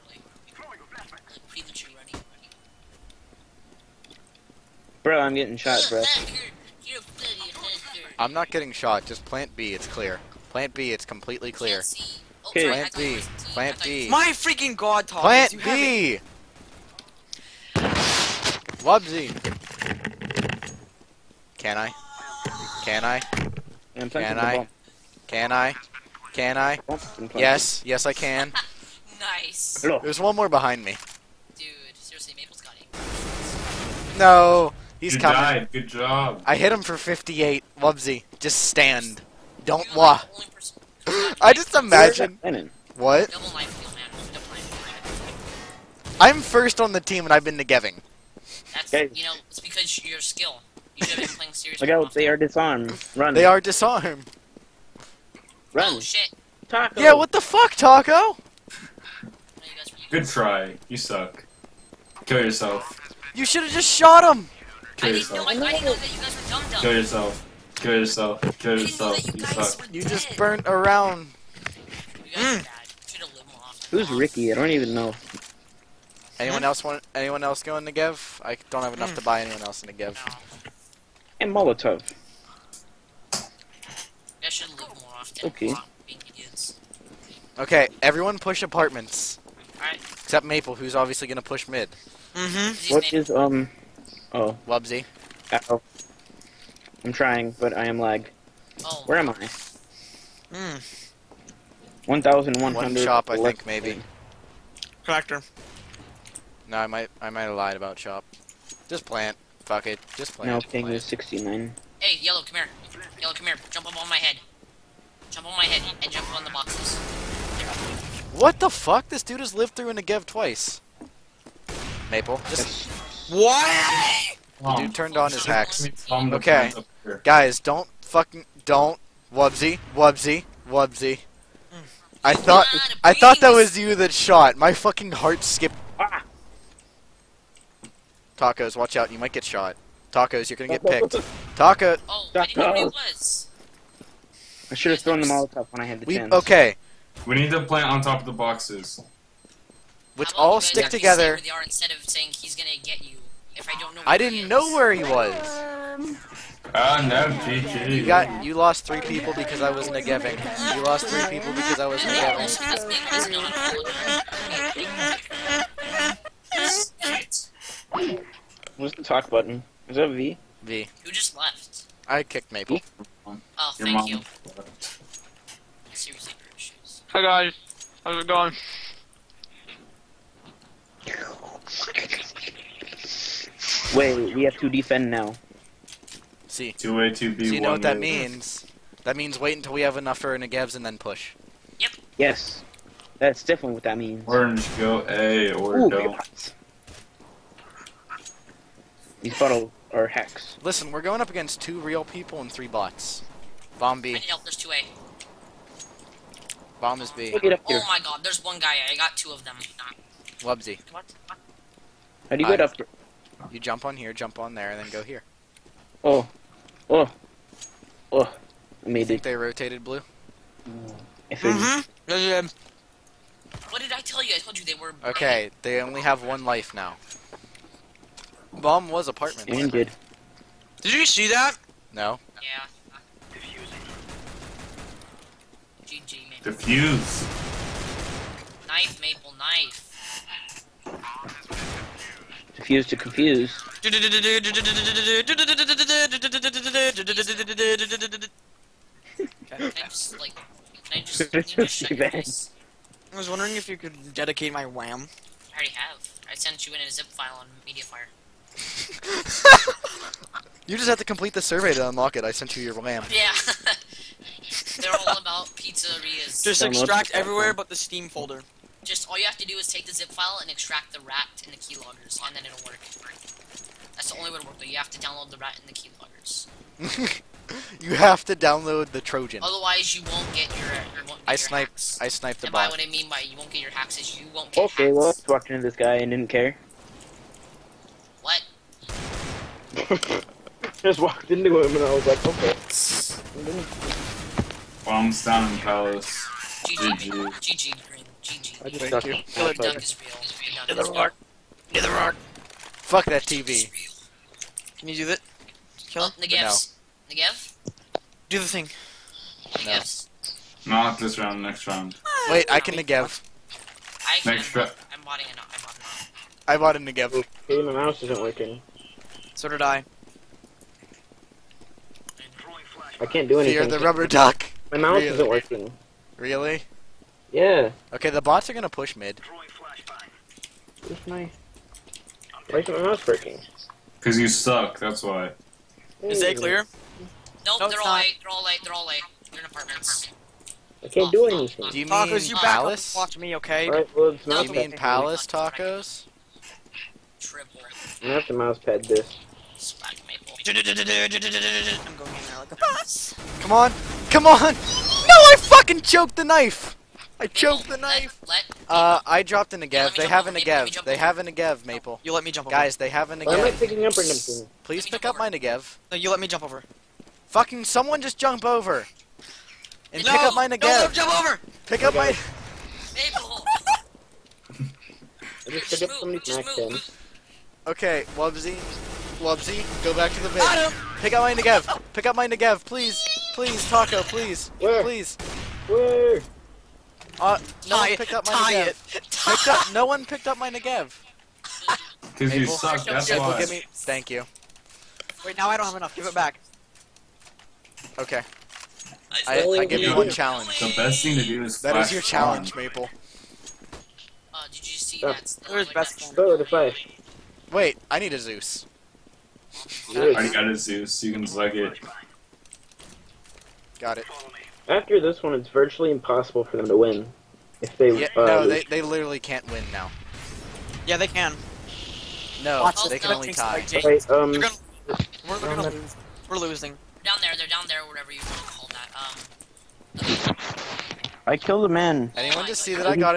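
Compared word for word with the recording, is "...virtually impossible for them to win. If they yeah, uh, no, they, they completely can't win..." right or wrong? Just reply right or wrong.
wrong.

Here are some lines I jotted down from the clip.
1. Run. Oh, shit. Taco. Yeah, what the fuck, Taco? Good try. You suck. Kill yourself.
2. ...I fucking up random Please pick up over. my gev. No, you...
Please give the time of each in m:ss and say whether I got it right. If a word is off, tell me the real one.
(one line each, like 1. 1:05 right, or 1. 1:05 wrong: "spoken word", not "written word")
1. 0:55 right
2. 6:03 wrong: "picking", not "fucking".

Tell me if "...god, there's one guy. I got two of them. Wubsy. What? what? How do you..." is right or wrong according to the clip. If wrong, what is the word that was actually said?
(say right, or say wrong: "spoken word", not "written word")
right.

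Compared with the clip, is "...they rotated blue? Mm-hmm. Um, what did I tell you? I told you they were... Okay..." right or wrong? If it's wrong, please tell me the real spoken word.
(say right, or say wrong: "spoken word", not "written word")
right.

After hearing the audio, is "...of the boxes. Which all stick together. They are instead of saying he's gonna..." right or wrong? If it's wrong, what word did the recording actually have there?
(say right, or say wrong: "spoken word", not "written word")
right.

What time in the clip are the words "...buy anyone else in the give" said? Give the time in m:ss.
1:19.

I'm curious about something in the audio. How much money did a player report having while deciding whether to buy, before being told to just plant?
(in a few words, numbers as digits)
1,100.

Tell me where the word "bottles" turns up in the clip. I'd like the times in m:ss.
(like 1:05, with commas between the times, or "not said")
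3:19.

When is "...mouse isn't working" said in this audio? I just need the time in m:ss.
5:17.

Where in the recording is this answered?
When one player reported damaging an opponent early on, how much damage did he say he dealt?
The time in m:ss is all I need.
0:36.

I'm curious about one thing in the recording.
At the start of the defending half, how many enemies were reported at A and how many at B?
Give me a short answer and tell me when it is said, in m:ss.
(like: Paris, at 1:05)
Two A, two B, at 3:06.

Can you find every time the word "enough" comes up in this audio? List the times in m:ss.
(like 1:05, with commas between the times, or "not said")
1:18, 3:09, 6:35.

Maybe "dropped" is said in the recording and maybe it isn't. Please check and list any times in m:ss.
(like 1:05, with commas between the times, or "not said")
5:59.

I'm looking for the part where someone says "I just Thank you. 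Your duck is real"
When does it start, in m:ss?
4:58.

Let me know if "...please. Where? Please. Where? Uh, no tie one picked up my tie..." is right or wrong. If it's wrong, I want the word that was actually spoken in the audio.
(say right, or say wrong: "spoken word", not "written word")
right.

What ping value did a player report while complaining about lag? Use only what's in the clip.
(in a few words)
69.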